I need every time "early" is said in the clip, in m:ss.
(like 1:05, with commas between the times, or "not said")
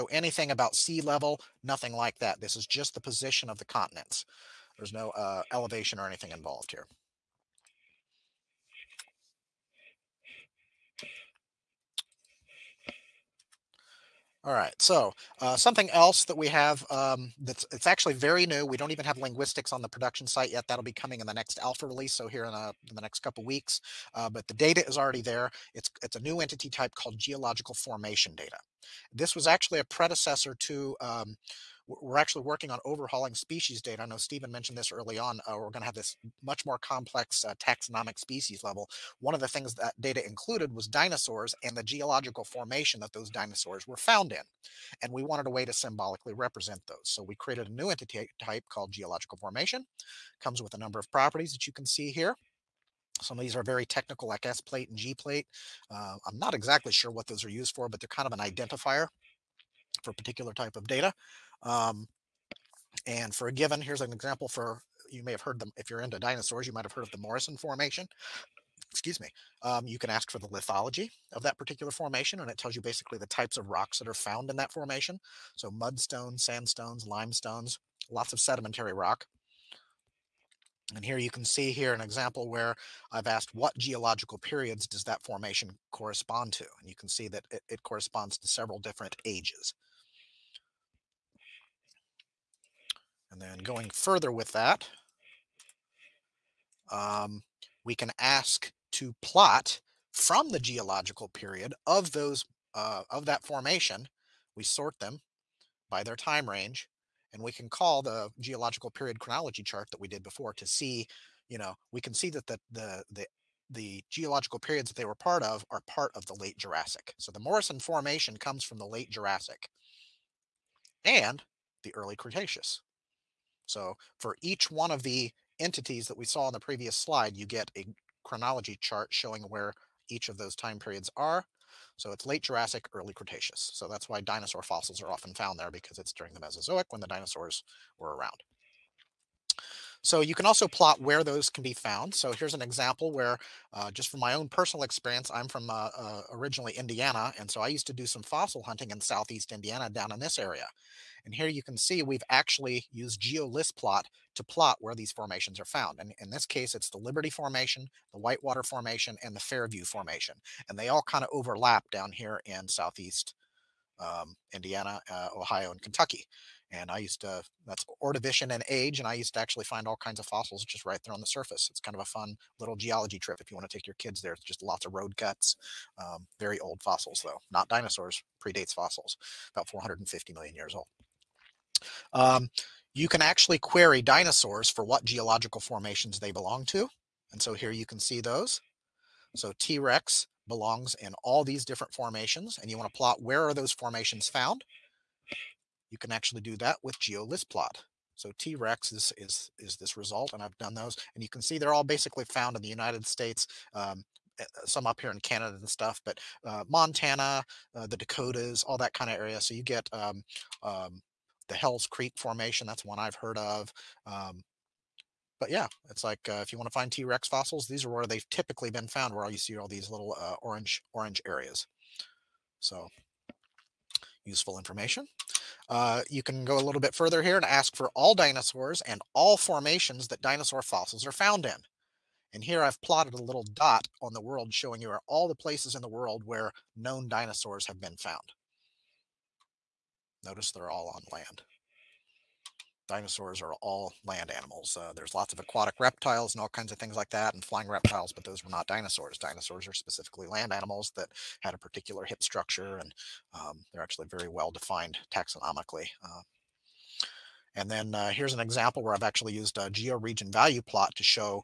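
0:34, 2:01, 2:12.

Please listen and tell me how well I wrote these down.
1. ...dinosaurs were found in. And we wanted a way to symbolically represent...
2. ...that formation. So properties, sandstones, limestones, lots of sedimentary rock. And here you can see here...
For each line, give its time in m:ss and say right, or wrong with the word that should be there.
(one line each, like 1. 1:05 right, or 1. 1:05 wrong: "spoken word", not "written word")
1. 0:43 right
2. 1:14 wrong: "mudstones", not "properties".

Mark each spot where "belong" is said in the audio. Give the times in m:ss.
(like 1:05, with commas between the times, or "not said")
3:06, 3:10.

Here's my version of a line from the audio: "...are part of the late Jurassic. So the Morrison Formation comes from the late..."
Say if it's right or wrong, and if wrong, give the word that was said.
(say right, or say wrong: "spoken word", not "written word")
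right.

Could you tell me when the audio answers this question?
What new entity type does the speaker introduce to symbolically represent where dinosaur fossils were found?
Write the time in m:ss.
0:27.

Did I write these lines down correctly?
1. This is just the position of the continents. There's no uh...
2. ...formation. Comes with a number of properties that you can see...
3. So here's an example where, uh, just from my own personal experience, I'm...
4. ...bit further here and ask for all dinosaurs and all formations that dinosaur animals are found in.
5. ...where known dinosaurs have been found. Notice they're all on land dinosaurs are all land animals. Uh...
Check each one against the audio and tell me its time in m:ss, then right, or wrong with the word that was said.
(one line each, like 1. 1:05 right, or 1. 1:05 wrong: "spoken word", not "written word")
1. 0:02 right
2. 0:49 right
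3. 2:22 right
4. 3:46 wrong: "fossils", not "animals"
5. 3:56 right.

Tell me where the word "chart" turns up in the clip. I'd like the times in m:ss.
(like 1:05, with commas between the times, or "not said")
1:49, 2:08.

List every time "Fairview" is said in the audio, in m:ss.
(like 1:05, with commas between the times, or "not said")
2:39.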